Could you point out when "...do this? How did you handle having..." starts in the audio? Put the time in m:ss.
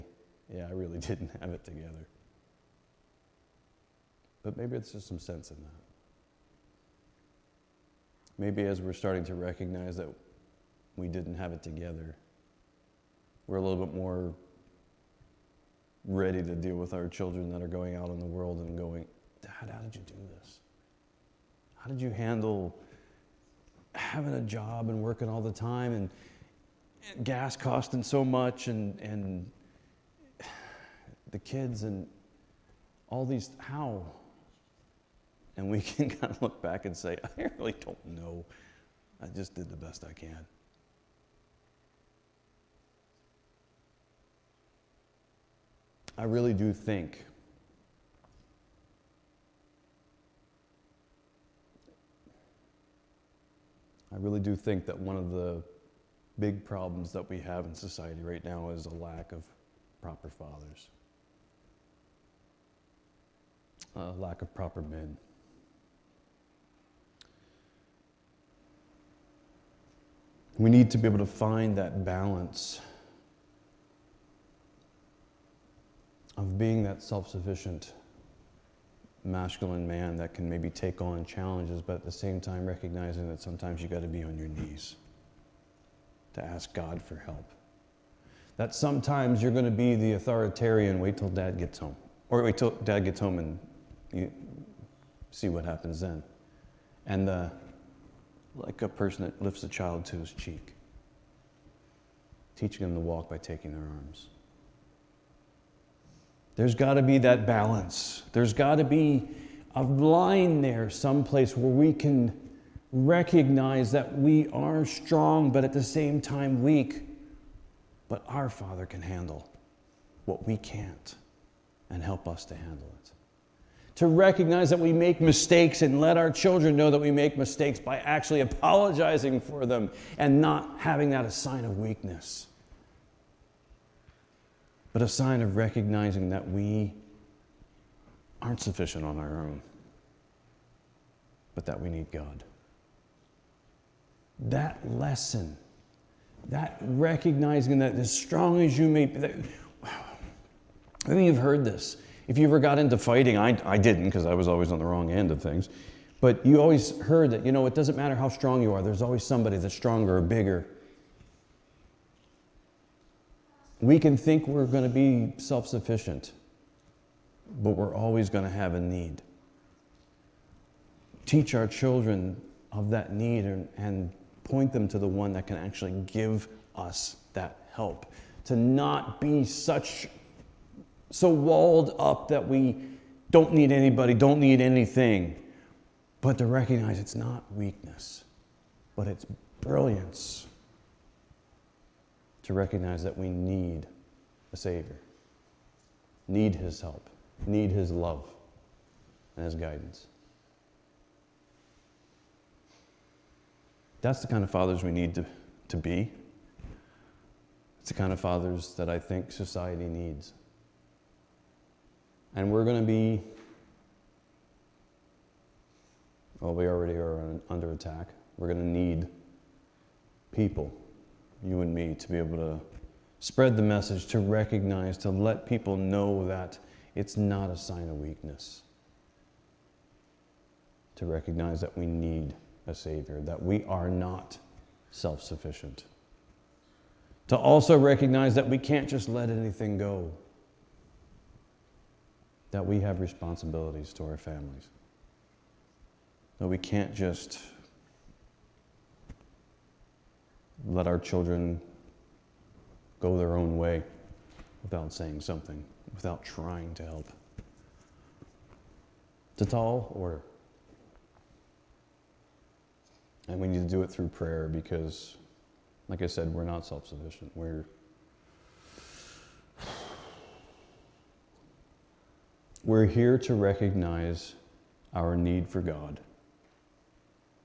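0:20.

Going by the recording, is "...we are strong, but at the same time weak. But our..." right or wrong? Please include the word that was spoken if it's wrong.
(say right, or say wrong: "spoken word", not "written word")
right.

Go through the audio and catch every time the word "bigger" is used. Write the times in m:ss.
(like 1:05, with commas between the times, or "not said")
2:40.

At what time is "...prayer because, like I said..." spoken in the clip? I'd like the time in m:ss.
4:24.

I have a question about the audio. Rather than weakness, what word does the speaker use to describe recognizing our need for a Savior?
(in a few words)
brilliance.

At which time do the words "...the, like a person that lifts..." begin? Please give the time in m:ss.
1:37.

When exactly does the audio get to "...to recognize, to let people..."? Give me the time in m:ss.
3:44.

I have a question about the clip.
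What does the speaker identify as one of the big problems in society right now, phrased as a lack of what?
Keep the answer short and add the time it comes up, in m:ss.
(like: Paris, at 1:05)
proper fathers, at 1:00.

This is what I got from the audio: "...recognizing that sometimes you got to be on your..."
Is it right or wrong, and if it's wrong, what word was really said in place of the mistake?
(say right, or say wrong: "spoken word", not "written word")
right.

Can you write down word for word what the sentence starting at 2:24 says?
That lesson, that recognizing that as strong as you may be, that, I you've heard this.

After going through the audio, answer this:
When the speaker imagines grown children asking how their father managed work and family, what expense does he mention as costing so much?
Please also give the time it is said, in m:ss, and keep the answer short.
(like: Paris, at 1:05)
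gas, at 0:27.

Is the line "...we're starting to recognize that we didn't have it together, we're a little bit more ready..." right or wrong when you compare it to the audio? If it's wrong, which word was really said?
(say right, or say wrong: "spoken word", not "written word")
right.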